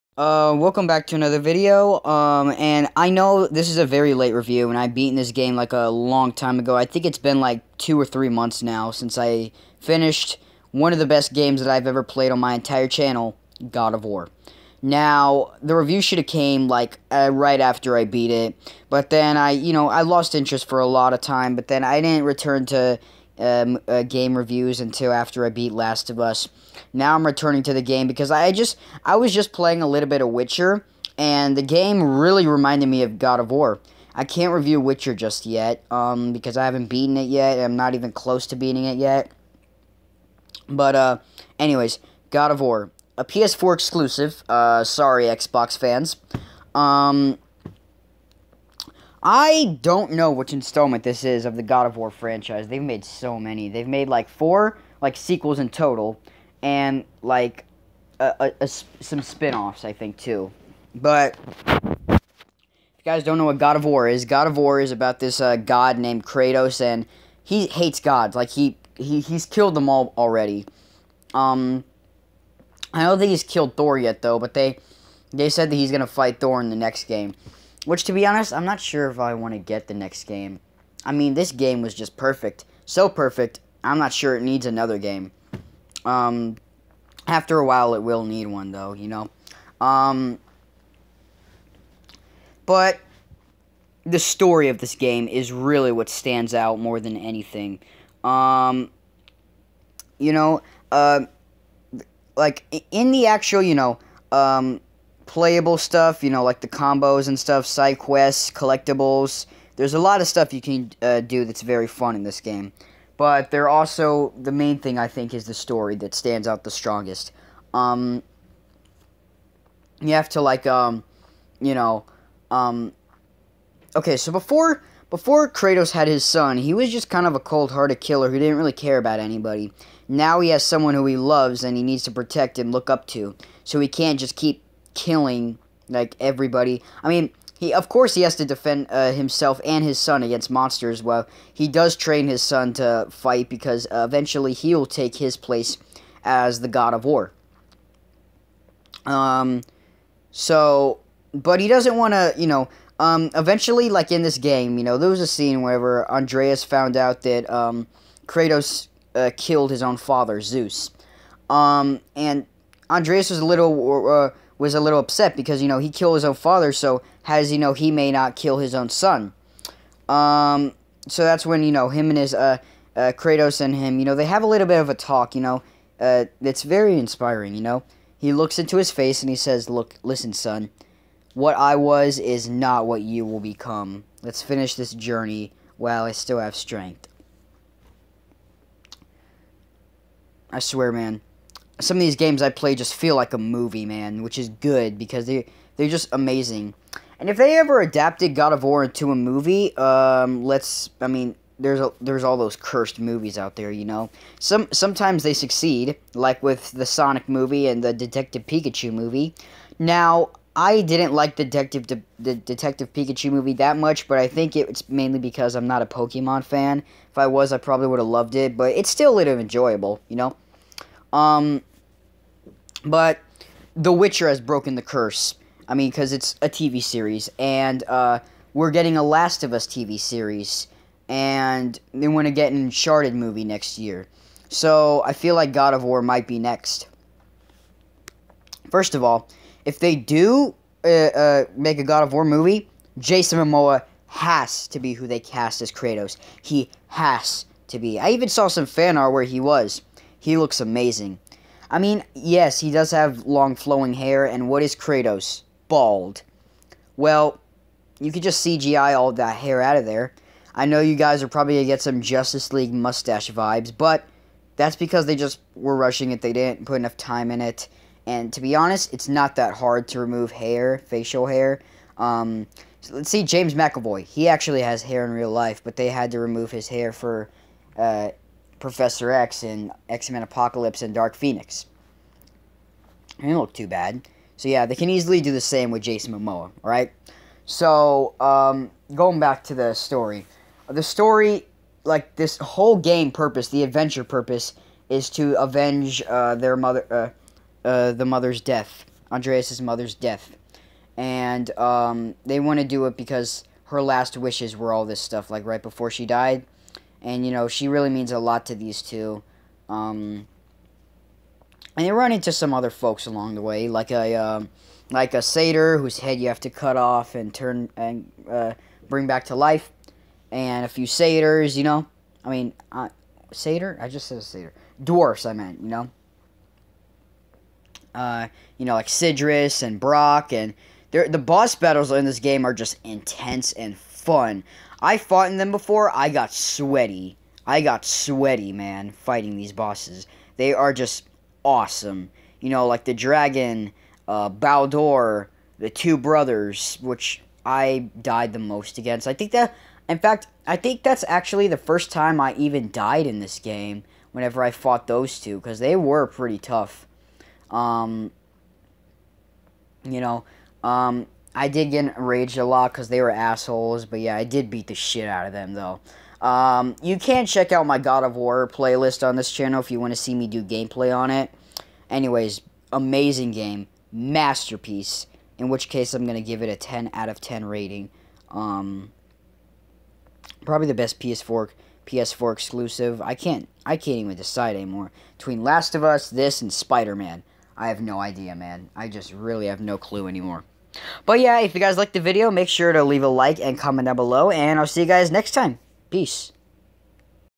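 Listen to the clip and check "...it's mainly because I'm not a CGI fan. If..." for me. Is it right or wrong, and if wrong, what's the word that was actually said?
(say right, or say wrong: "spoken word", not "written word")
wrong: "Pokemon", not "CGI".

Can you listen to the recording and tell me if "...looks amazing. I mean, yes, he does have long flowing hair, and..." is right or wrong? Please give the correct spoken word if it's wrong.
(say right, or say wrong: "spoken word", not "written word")
right.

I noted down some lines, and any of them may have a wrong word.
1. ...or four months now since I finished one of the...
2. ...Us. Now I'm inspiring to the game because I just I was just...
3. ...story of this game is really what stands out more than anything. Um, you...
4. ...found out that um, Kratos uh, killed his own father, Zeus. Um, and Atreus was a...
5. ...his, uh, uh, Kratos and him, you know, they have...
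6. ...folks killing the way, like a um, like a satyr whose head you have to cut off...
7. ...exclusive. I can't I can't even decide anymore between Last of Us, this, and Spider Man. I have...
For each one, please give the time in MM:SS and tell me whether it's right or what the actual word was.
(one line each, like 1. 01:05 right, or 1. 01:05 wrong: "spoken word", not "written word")
1. 00:07 wrong: "three", not "four"
2. 00:26 wrong: "returning", not "inspiring"
3. 01:34 right
4. 02:36 right
5. 02:52 right
6. 05:12 wrong: "along", not "killing"
7. 06:22 right.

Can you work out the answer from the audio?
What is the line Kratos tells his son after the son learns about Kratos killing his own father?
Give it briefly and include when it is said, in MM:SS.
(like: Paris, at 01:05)
What I was is not what you will become, at 03:01.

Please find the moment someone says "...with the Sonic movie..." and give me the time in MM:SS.
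03:26.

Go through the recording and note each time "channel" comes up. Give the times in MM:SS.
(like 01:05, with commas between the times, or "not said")
00:12, 06:09.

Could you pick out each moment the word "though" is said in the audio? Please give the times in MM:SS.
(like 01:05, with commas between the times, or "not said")
01:14, 01:28, 06:05.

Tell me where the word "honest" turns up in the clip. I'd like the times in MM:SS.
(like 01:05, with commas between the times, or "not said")
01:18, 04:28.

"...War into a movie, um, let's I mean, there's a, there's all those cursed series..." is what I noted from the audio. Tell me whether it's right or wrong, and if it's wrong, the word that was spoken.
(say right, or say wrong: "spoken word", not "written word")
wrong: "movies", not "series".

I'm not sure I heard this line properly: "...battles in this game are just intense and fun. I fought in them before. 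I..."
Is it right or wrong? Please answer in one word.
right.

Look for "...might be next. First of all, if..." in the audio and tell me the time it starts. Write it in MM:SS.
03:56.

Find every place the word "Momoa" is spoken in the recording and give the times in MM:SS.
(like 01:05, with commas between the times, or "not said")
04:03, 04:46.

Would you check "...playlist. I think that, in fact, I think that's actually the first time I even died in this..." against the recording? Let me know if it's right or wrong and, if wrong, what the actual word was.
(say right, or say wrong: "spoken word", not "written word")
wrong: "against", not "playlist".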